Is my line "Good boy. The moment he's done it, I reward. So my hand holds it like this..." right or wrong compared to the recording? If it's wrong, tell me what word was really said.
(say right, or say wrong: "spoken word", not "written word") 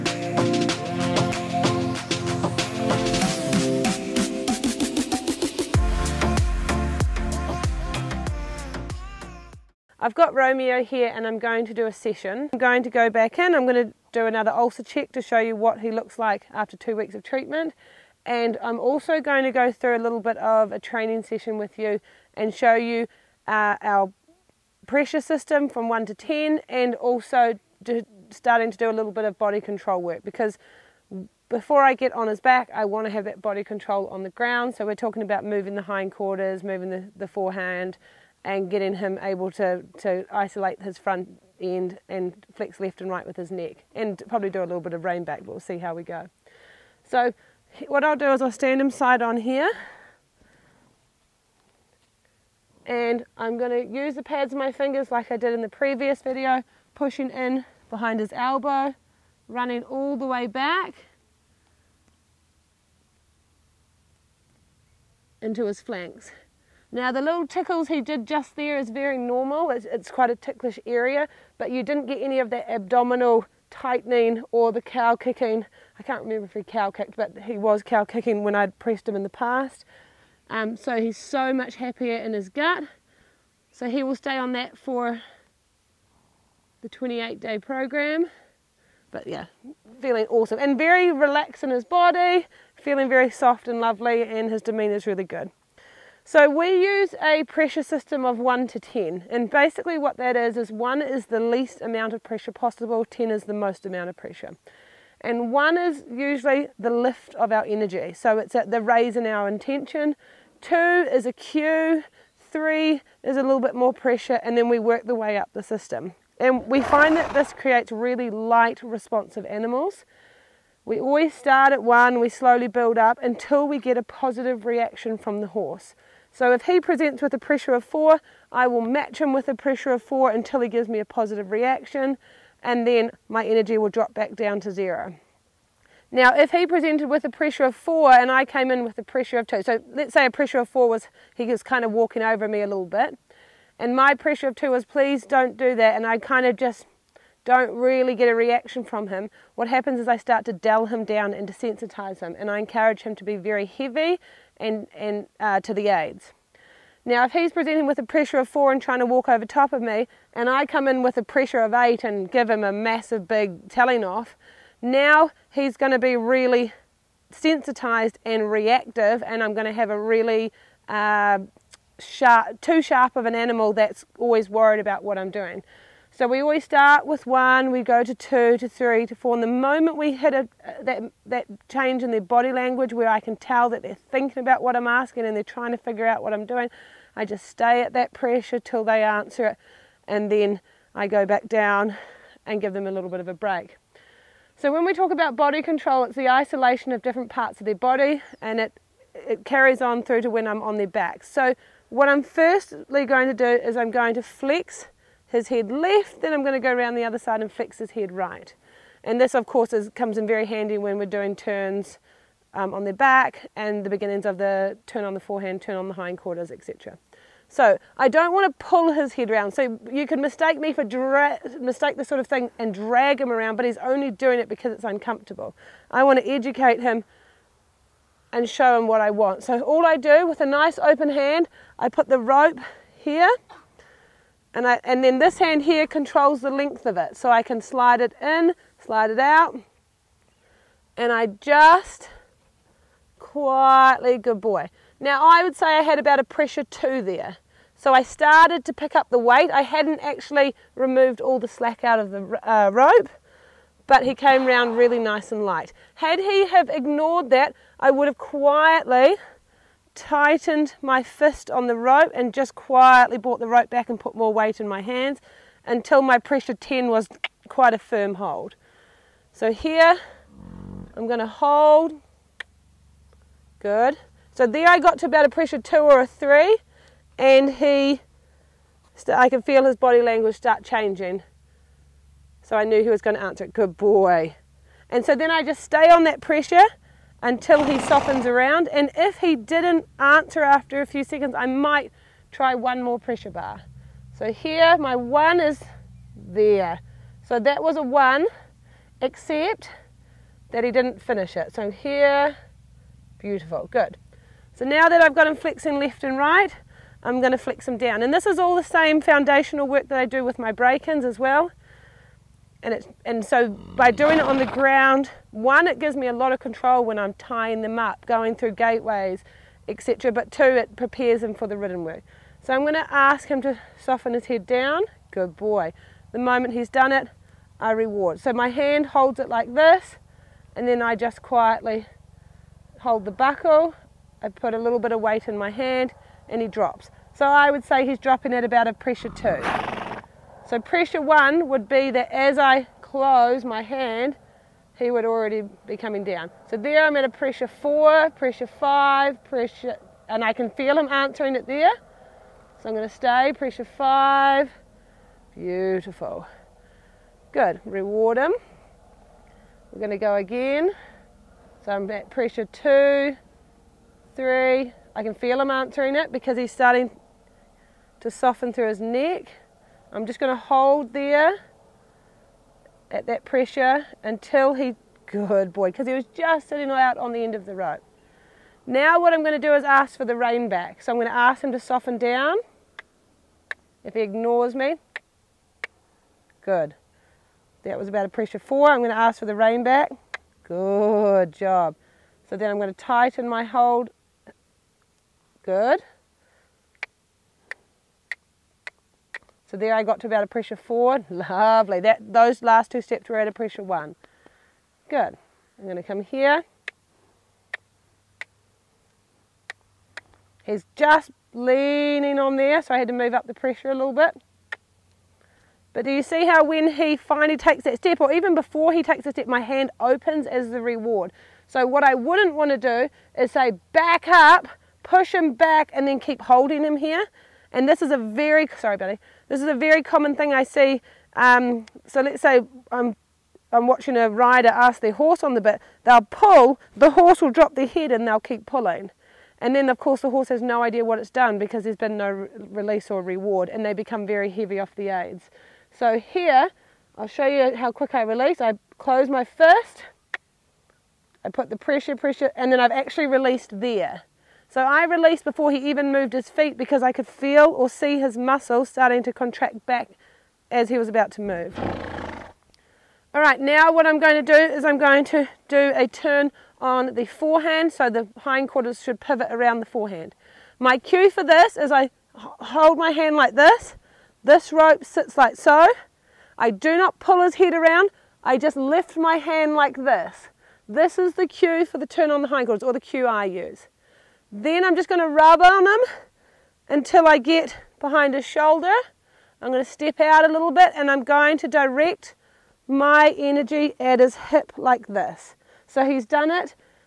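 right.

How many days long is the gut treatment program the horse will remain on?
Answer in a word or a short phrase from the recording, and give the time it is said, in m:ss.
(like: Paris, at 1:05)
28, at 1:26.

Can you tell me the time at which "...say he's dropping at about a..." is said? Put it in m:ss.
5:37.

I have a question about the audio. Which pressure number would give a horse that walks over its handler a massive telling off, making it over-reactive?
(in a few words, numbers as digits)
8.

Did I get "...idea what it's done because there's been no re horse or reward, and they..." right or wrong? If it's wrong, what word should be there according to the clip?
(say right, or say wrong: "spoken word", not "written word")
wrong: "release", not "horse".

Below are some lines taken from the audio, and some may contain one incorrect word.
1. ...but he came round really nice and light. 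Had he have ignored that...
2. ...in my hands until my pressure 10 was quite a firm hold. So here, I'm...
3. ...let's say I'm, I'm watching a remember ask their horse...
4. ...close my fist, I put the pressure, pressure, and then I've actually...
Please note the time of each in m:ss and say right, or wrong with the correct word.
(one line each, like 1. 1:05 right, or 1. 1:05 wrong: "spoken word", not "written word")
1. 4:13 right
2. 4:24 right
3. 7:12 wrong: "rider", not "remember"
4. 7:28 right.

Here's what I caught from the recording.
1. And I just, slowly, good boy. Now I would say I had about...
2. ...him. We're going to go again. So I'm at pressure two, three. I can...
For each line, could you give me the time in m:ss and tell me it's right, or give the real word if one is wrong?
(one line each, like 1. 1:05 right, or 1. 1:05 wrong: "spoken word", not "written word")
1. 4:00 wrong: "quietly", not "slowly"
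2. 5:58 right.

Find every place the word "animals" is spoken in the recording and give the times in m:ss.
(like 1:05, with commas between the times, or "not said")
1:59, 2:53.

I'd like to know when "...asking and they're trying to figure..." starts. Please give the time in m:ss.
3:04.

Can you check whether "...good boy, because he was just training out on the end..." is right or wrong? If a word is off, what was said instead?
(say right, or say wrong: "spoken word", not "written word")
wrong: "sitting", not "training".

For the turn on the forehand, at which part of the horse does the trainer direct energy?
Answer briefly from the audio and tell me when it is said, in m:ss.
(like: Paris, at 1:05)
his hip, at 8:13.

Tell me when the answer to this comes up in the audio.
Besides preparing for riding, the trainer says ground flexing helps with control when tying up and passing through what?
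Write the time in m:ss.
5:18.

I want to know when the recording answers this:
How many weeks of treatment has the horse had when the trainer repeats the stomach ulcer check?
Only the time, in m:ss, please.
0:16.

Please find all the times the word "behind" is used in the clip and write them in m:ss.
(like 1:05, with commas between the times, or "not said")
0:57, 8:07.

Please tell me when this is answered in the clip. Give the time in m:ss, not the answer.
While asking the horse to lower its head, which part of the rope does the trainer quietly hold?
5:33.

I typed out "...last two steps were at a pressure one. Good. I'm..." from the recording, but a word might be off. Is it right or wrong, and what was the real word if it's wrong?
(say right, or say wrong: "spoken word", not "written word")
right.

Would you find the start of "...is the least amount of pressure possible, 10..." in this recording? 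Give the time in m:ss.
1:41.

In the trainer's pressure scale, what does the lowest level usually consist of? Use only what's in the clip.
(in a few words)
the lift of our energy.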